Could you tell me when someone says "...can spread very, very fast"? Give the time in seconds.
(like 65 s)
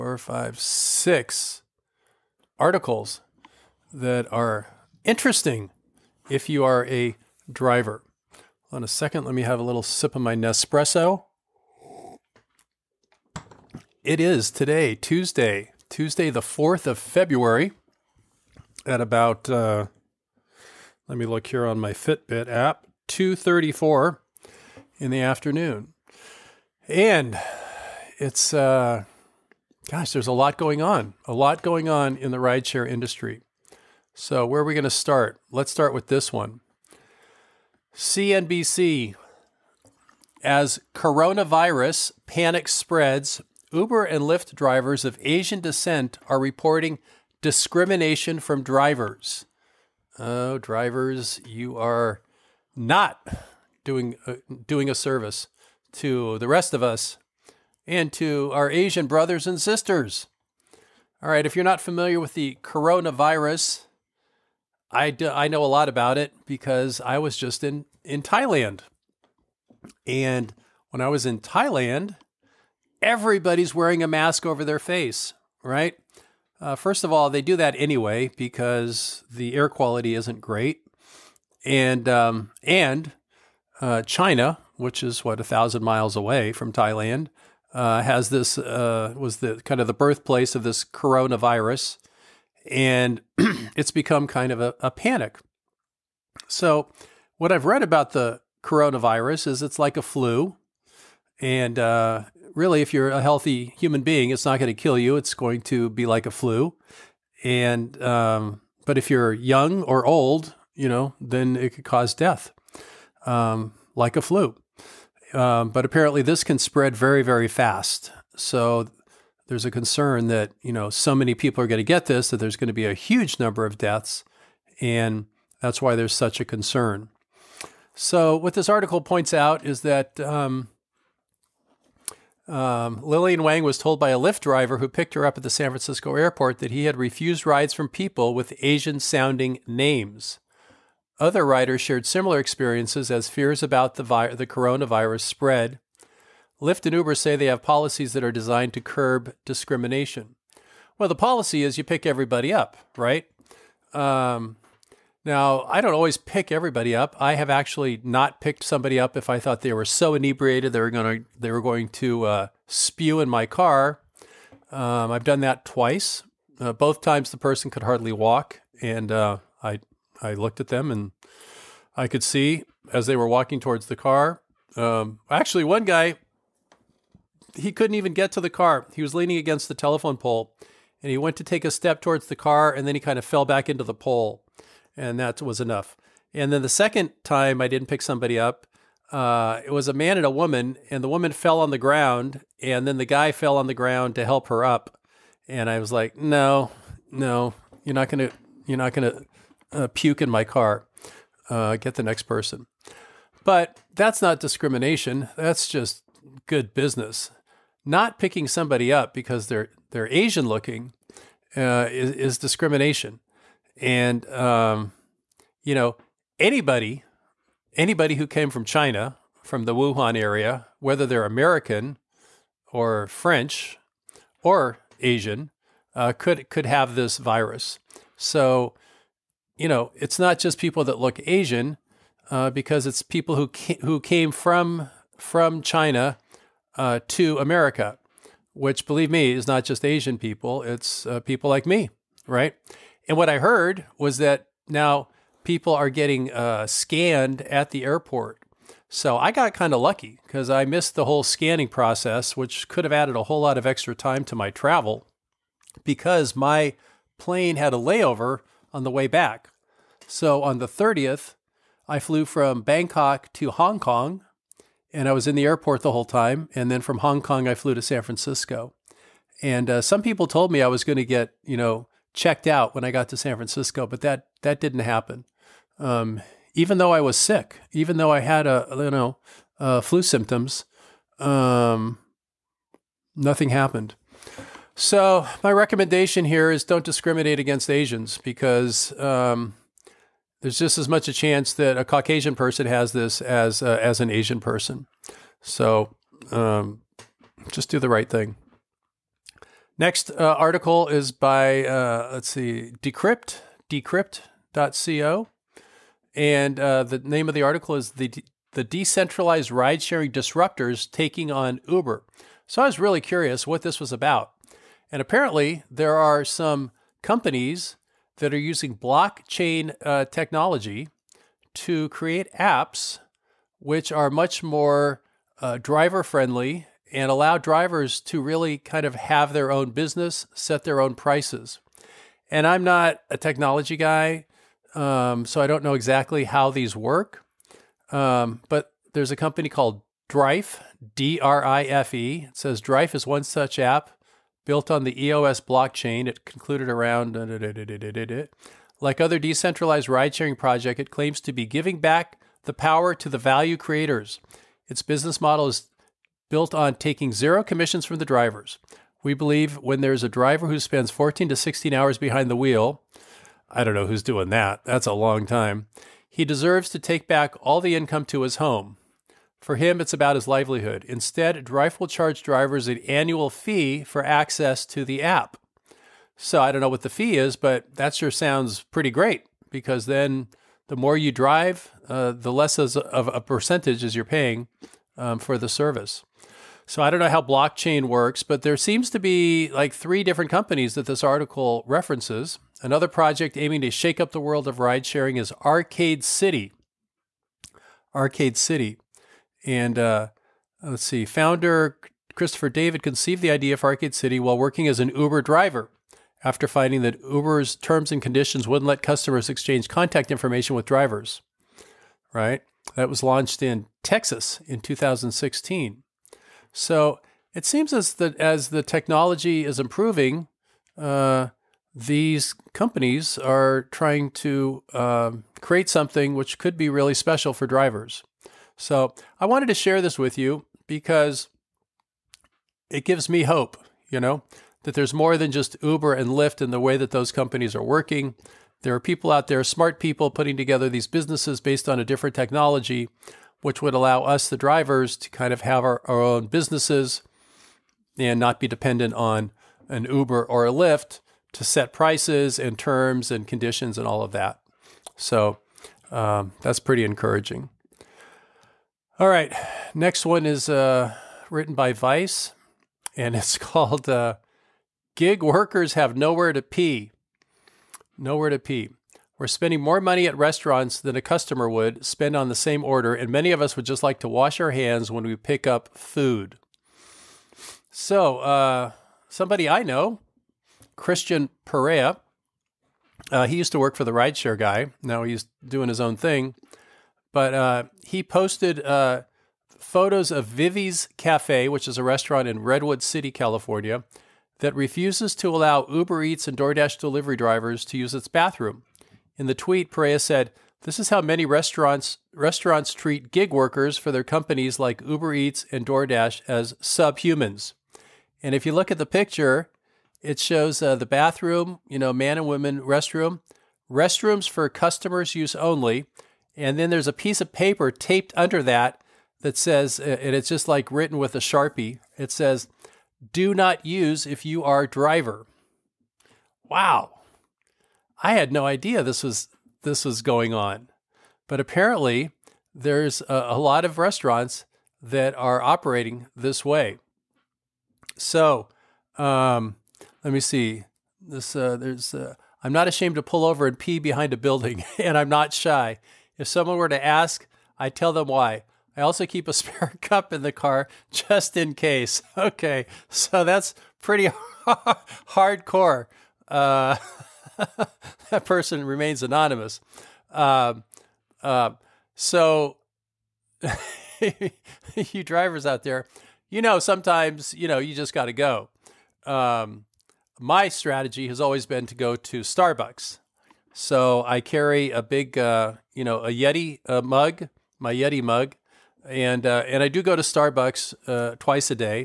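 116 s.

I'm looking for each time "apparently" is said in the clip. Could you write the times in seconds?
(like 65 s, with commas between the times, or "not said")
115 s, 315 s, 531 s.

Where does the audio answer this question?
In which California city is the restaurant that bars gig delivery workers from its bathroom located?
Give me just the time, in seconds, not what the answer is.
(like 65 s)
492 s.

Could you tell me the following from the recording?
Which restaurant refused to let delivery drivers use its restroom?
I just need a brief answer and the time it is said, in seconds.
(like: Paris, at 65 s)
Vivi's Cafe, at 490 s.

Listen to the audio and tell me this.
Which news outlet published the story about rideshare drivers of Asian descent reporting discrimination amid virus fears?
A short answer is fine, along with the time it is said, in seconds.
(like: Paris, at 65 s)
CNBC, at 37 s.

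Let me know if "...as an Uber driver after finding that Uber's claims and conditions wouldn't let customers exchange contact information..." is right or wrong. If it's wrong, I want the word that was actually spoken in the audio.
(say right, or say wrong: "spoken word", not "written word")
wrong: "terms", not "claims".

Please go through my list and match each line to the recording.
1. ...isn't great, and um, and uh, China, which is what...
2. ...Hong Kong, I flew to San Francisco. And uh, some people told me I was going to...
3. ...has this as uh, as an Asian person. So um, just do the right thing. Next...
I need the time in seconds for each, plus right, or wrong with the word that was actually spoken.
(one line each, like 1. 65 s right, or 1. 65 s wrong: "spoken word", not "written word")
1. 80 s right
2. 266 s right
3. 292 s right.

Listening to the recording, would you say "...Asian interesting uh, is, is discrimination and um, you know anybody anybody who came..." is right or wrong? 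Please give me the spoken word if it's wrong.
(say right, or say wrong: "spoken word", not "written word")
wrong: "looking", not "interesting".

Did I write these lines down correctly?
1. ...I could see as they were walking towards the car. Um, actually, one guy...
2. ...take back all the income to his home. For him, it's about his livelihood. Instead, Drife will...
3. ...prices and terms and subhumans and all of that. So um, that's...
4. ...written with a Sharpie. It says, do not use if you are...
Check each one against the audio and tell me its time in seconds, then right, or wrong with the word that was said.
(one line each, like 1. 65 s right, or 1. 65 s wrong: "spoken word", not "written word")
1. 171 s right
2. 366 s right
3. 451 s wrong: "conditions", not "subhumans"
4. 520 s right.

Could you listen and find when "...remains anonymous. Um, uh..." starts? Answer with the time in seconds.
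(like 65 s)
558 s.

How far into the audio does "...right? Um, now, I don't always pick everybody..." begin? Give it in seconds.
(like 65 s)
152 s.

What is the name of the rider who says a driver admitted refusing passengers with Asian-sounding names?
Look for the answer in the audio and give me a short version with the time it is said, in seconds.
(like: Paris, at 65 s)
Lillian Wang, at 133 s.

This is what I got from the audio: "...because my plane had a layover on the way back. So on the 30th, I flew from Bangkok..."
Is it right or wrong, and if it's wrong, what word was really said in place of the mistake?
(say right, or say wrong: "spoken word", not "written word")
right.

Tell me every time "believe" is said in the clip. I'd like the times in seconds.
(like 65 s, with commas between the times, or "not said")
238 s, 359 s.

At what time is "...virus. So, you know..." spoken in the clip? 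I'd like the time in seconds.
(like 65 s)
227 s.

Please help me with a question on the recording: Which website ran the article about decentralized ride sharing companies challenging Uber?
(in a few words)
Decrypt.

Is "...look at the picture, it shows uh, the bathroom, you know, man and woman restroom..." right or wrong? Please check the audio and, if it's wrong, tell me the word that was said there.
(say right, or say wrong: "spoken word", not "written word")
right.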